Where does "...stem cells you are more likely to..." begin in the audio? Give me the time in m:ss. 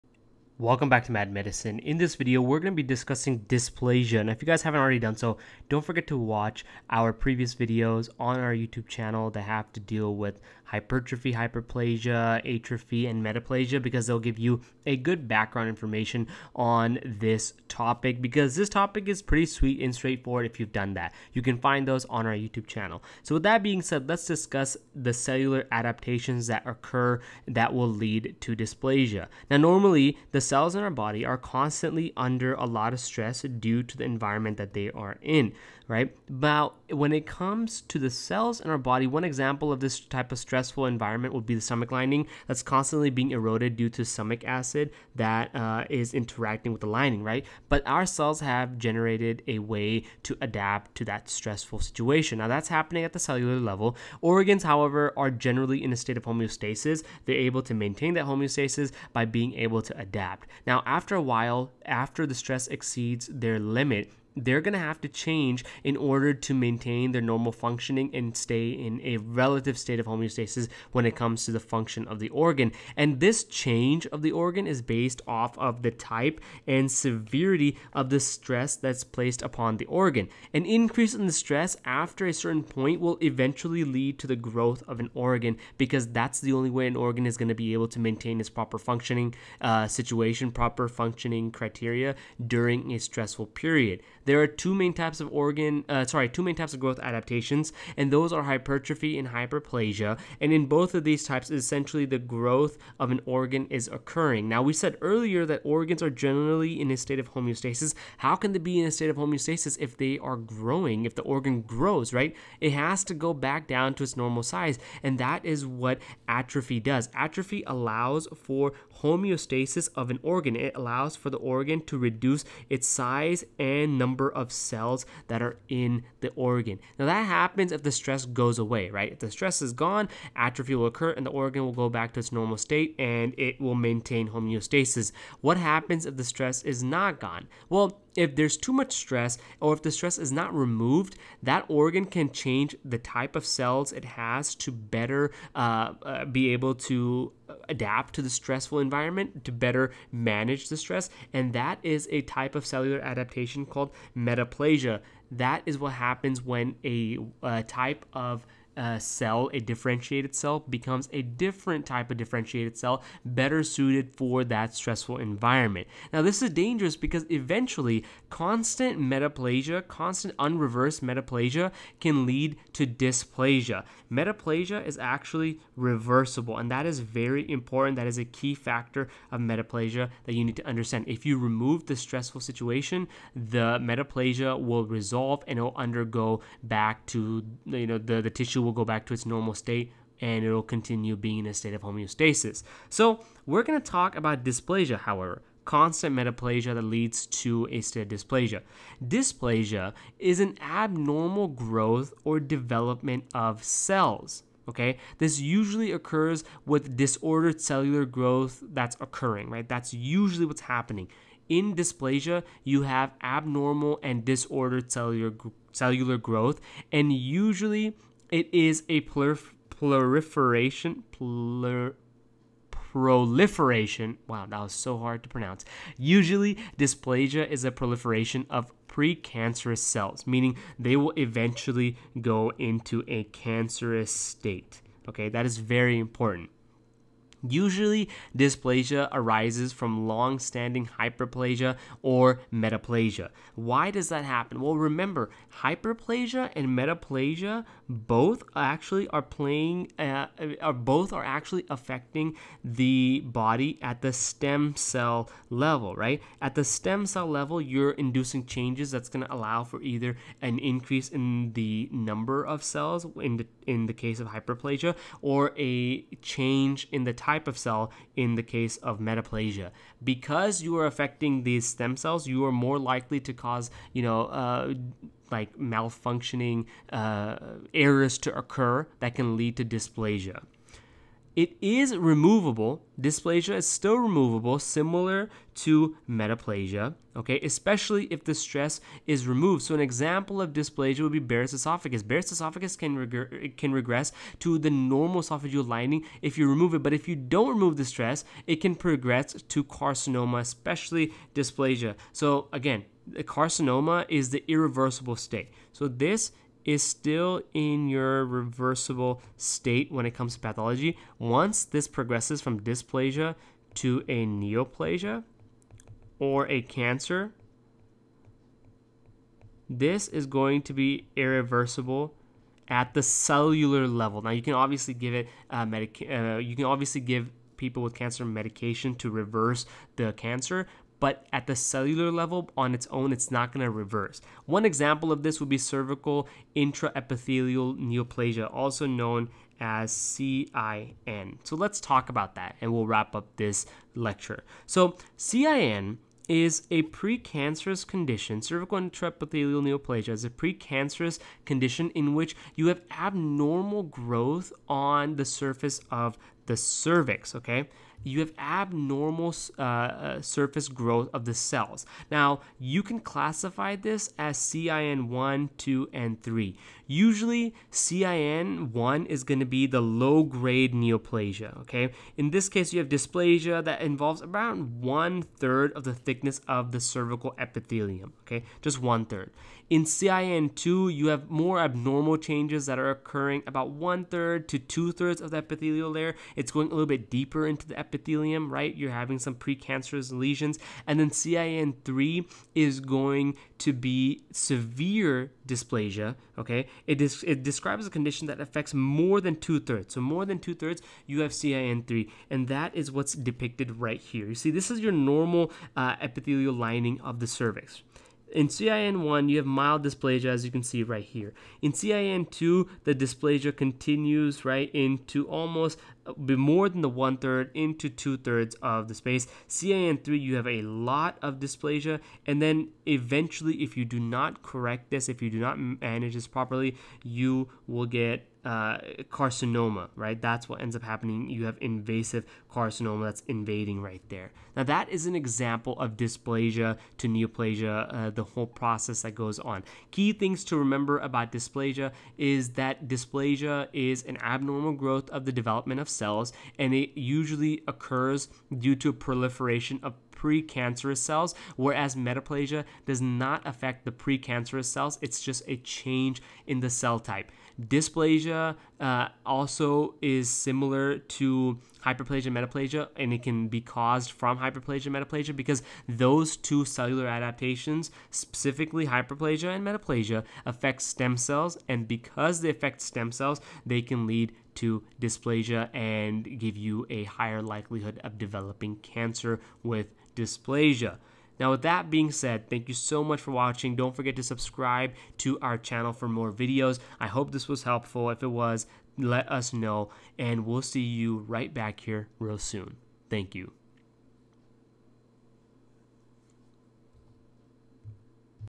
4:31.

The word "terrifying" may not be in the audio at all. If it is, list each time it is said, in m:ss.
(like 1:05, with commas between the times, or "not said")
not said.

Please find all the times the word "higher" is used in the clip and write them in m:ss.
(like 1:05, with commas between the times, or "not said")
7:57.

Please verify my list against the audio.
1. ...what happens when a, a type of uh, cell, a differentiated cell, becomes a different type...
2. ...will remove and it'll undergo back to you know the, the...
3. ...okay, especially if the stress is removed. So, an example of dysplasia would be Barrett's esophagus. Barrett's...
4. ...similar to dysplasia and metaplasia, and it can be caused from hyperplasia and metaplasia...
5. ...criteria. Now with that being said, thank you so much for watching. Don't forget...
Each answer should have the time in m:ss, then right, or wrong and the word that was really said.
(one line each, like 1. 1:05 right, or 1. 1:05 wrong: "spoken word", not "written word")
1. 2:35 right
2. 3:04 wrong: "resolve", not "remove"
3. 4:47 right
4. 7:40 wrong: "hyperplasia", not "dysplasia"
5. 8:00 wrong: "dysplasia", not "criteria".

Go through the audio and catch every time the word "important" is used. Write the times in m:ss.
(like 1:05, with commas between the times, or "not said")
2:57, 3:55.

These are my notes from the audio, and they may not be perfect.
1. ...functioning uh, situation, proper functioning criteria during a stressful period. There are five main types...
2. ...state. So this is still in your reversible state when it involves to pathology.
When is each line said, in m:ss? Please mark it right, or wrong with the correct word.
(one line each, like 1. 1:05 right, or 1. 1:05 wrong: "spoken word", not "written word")
1. 1:28 wrong: "two", not "five"
2. 5:05 wrong: "comes", not "involves".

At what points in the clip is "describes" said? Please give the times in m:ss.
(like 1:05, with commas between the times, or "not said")
6:37.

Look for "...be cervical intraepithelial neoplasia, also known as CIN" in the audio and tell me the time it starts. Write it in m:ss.
5:35.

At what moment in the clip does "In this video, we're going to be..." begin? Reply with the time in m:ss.
0:01.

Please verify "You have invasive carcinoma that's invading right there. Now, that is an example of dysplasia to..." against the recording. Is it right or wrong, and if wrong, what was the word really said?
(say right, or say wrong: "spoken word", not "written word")
right.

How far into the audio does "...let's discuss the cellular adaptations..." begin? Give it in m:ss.
0:24.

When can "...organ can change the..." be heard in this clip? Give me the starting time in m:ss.
2:21.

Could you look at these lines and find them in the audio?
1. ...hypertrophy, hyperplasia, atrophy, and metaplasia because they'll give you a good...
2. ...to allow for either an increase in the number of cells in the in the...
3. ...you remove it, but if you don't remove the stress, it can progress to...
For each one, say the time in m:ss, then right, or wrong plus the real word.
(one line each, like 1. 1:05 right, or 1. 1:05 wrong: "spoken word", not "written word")
1. 0:10 right
2. 4:19 right
3. 4:56 right.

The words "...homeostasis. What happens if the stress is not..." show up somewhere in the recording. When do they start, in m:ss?
2:14.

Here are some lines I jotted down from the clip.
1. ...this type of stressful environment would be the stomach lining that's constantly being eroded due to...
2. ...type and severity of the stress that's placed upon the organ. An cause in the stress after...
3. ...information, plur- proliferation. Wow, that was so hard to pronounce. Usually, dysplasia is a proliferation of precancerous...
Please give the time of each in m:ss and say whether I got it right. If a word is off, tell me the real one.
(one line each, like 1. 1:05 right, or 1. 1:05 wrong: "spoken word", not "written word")
1. 0:39 right
2. 1:15 wrong: "increase", not "cause"
3. 3:39 wrong: "proliferation", not "information".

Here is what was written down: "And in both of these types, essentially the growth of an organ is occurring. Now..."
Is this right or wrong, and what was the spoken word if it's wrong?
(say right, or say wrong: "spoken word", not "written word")
right.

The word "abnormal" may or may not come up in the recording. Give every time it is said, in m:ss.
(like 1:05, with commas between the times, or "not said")
3:20, 3:33, 5:52, 5:58, 6:21, 7:24.